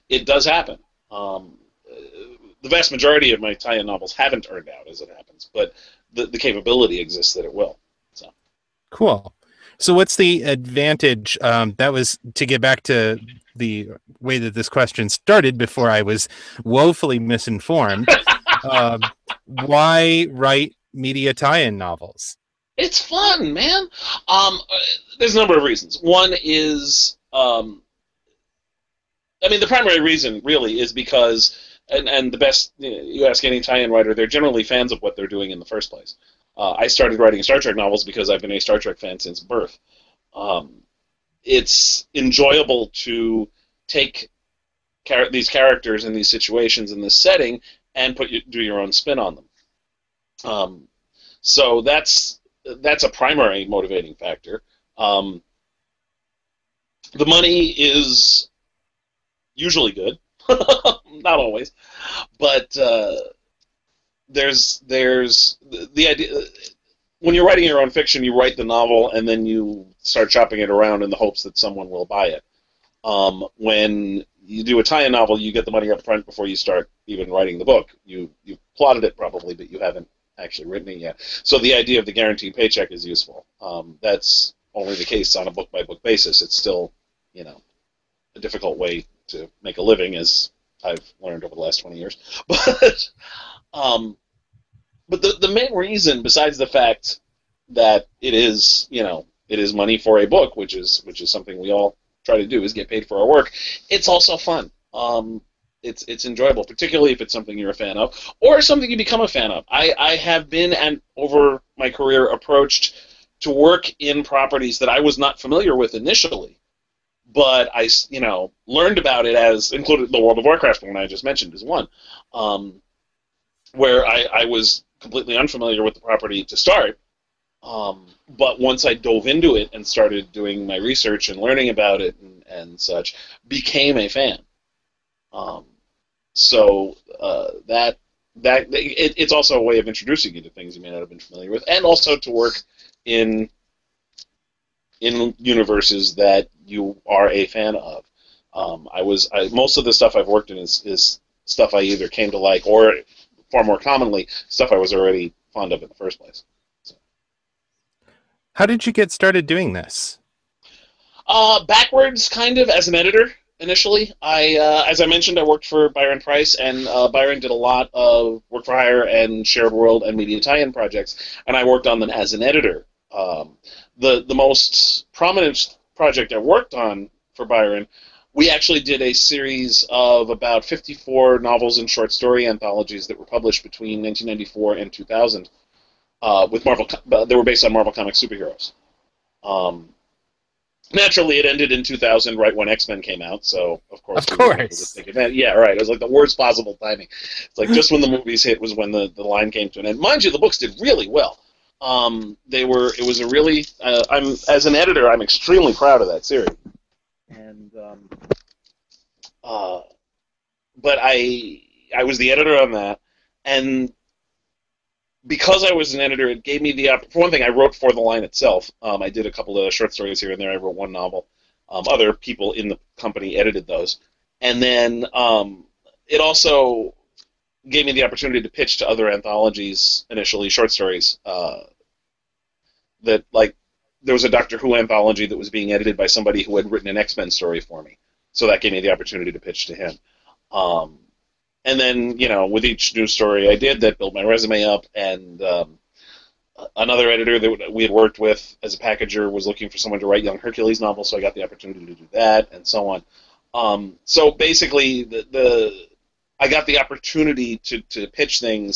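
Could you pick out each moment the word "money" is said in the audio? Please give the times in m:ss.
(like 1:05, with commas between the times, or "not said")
0:57, 1:15, 1:39.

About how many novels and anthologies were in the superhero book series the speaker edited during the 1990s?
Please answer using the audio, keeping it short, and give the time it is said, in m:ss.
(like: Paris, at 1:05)
54, at 3:00.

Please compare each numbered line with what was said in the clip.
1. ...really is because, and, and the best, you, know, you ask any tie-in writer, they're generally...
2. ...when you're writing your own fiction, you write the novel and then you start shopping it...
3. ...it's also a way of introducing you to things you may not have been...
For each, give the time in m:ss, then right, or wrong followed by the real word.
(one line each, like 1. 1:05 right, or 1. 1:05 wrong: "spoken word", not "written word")
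1. 0:30 right
2. 1:07 right
3. 2:19 right.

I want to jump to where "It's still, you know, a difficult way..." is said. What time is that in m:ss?
1:26.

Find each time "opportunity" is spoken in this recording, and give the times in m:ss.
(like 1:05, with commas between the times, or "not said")
3:48, 3:58, 4:11, 4:16.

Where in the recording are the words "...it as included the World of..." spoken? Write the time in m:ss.
1:59.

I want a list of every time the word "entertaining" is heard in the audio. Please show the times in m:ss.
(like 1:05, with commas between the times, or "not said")
not said.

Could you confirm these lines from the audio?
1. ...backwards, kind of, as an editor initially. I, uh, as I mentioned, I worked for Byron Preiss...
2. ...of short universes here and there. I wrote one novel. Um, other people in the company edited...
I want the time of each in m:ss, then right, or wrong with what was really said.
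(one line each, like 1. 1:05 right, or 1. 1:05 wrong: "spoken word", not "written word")
1. 2:41 right
2. 3:39 wrong: "stories", not "universes".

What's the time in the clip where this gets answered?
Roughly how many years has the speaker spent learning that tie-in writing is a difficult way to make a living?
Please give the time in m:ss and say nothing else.
1:31.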